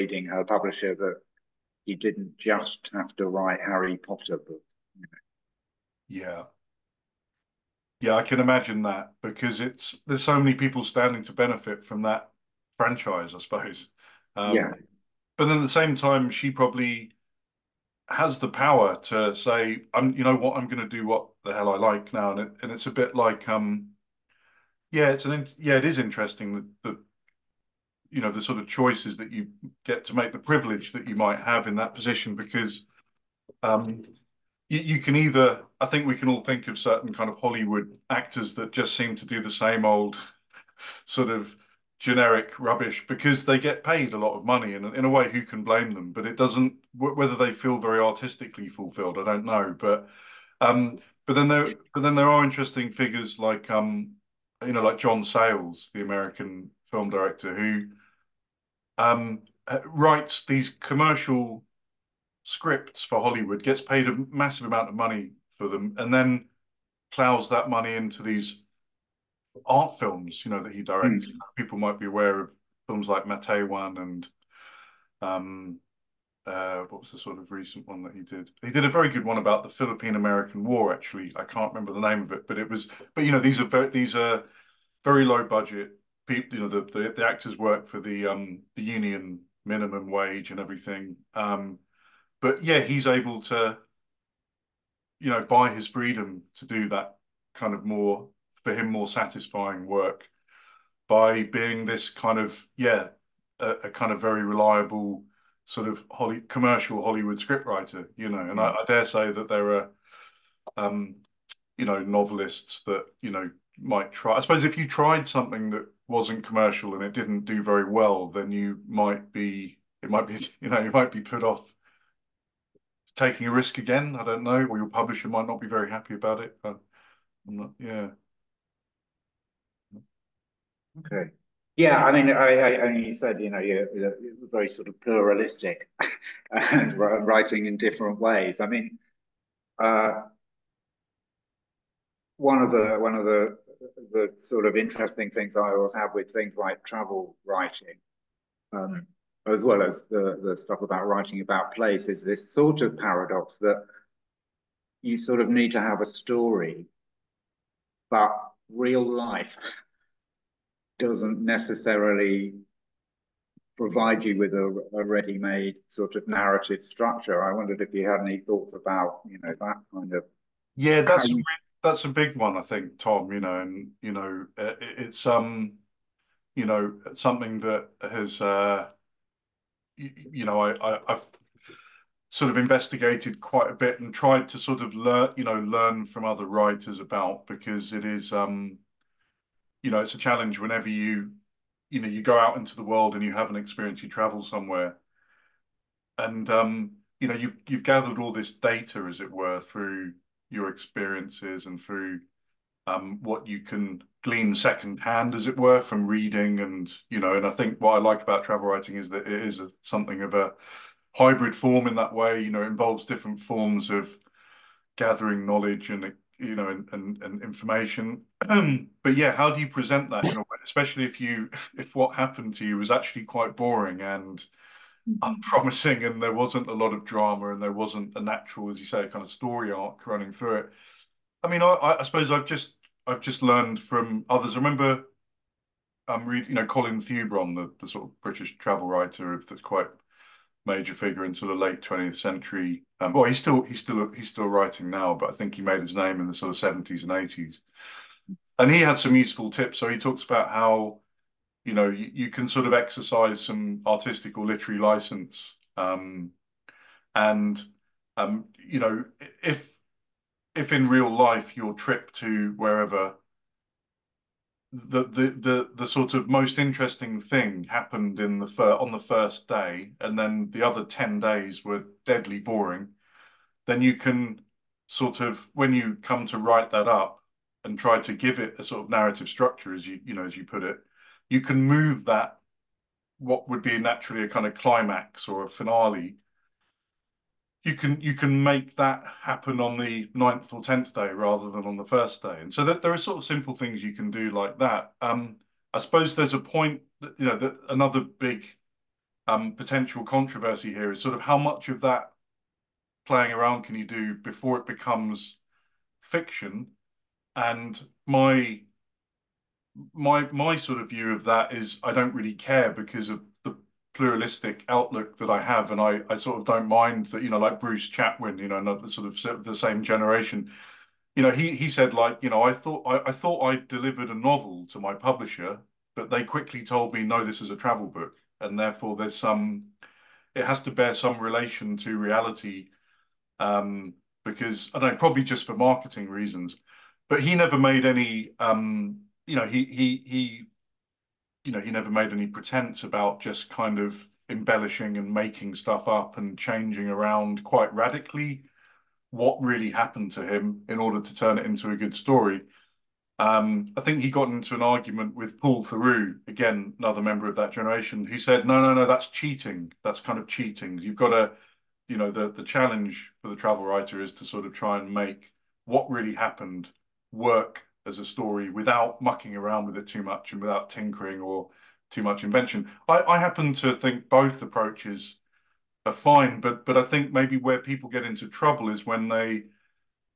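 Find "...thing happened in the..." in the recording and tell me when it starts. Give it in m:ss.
4:27.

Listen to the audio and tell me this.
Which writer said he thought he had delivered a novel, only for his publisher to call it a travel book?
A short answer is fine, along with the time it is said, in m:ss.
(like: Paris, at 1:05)
Bruce Chatwin, at 5:17.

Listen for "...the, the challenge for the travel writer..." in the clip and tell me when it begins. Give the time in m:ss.
6:02.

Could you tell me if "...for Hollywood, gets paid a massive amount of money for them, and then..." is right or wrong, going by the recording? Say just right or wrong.
right.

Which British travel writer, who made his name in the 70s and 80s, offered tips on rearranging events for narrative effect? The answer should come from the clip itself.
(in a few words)
Colin Thubron.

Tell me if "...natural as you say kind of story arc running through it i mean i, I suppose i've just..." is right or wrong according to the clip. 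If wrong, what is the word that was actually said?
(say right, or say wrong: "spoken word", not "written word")
right.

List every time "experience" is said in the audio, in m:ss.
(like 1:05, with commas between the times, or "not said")
3:13, 3:20.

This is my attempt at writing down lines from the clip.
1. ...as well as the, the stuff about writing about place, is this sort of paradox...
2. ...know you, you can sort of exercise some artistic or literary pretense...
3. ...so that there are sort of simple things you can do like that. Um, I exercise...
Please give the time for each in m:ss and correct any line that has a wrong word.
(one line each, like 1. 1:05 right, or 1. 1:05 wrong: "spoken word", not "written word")
1. 2:29 right
2. 4:11 wrong: "license", not "pretense"
3. 4:52 wrong: "suppose", not "exercise".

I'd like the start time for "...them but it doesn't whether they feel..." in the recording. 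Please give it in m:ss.
0:45.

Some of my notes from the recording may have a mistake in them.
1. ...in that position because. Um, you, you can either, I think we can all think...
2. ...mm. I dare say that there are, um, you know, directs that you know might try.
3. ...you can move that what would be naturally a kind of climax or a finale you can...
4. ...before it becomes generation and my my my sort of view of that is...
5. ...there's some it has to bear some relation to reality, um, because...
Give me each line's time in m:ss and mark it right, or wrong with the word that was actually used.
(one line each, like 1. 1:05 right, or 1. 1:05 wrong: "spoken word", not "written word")
1. 0:31 right
2. 1:48 wrong: "novelists", not "directs"
3. 4:41 right
4. 5:04 wrong: "fiction", not "generation"
5. 5:28 right.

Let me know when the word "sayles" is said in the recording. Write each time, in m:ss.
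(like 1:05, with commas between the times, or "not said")
0:55.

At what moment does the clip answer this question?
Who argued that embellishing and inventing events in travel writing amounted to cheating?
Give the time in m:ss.
5:55.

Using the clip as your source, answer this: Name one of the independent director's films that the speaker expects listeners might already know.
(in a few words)
Matewan.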